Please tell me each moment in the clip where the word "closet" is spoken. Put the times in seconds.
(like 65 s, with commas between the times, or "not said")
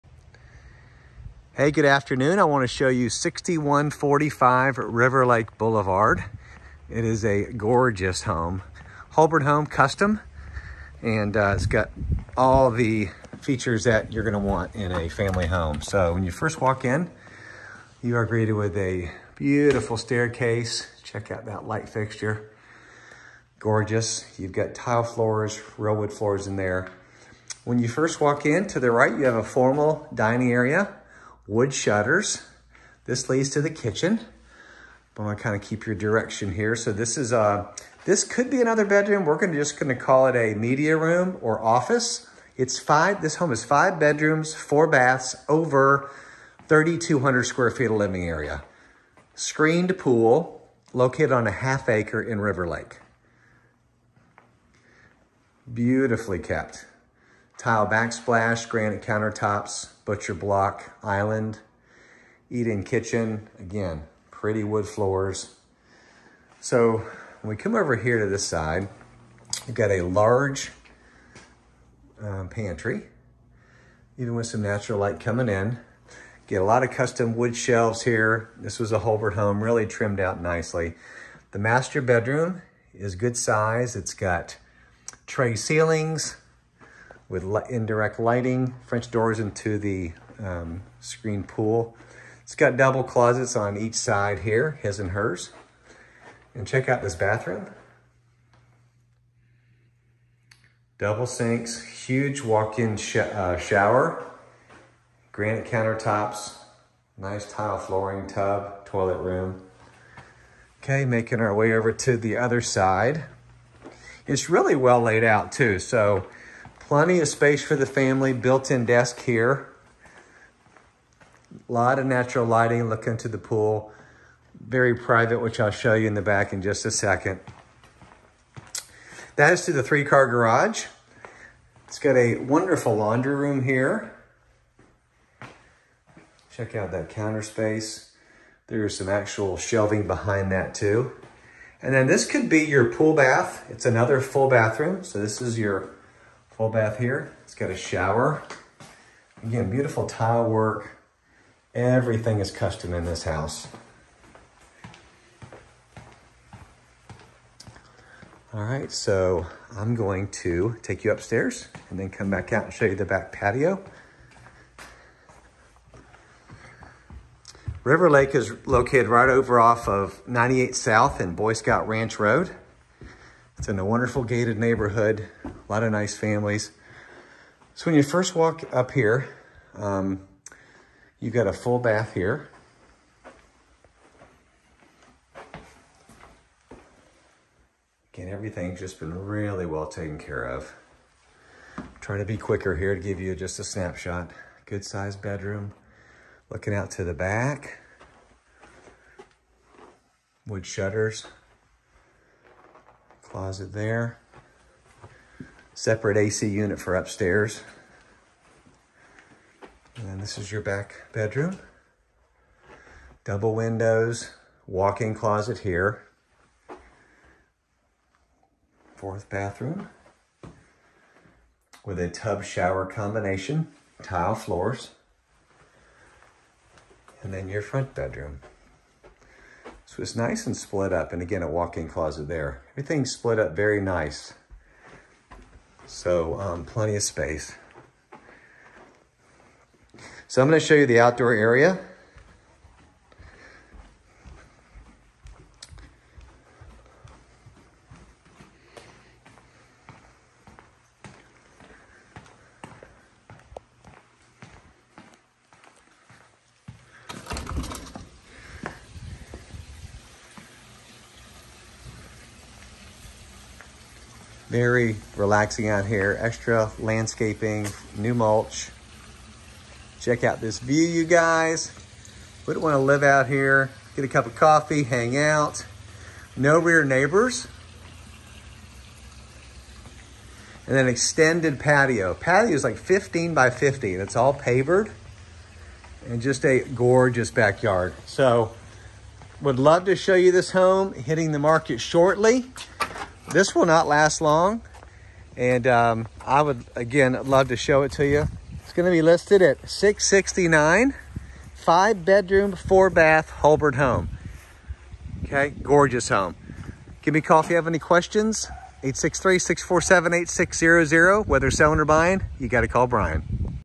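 93 s, 203 s, 215 s, 231 s.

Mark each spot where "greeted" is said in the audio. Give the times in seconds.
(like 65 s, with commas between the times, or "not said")
18 s.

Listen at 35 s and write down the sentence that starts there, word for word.
I'm gonna kind of keep your direction here.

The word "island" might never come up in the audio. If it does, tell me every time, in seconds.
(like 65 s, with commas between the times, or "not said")
61 s.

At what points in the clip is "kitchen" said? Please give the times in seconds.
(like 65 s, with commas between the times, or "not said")
33 s, 62 s.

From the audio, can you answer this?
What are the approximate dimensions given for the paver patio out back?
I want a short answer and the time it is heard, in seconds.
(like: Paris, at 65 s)
15 by 50, at 282 s.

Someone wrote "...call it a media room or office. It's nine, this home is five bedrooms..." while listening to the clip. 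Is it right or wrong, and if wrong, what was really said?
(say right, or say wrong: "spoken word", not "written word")
wrong: "five", not "nine".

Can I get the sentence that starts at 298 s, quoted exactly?
It's going to be listed at 669 five bedroom, four bath, Hulbert home.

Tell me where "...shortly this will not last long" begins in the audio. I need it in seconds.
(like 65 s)
291 s.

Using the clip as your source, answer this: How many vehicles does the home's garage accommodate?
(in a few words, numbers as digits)
3.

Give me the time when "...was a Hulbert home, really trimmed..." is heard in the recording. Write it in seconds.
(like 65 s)
78 s.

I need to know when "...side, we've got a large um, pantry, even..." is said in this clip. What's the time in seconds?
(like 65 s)
68 s.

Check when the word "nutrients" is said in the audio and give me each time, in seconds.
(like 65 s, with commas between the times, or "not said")
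not said.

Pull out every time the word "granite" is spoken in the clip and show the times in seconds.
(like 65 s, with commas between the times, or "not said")
58 s, 105 s.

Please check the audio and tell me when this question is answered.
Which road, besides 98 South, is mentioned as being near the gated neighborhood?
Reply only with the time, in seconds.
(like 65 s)
171 s.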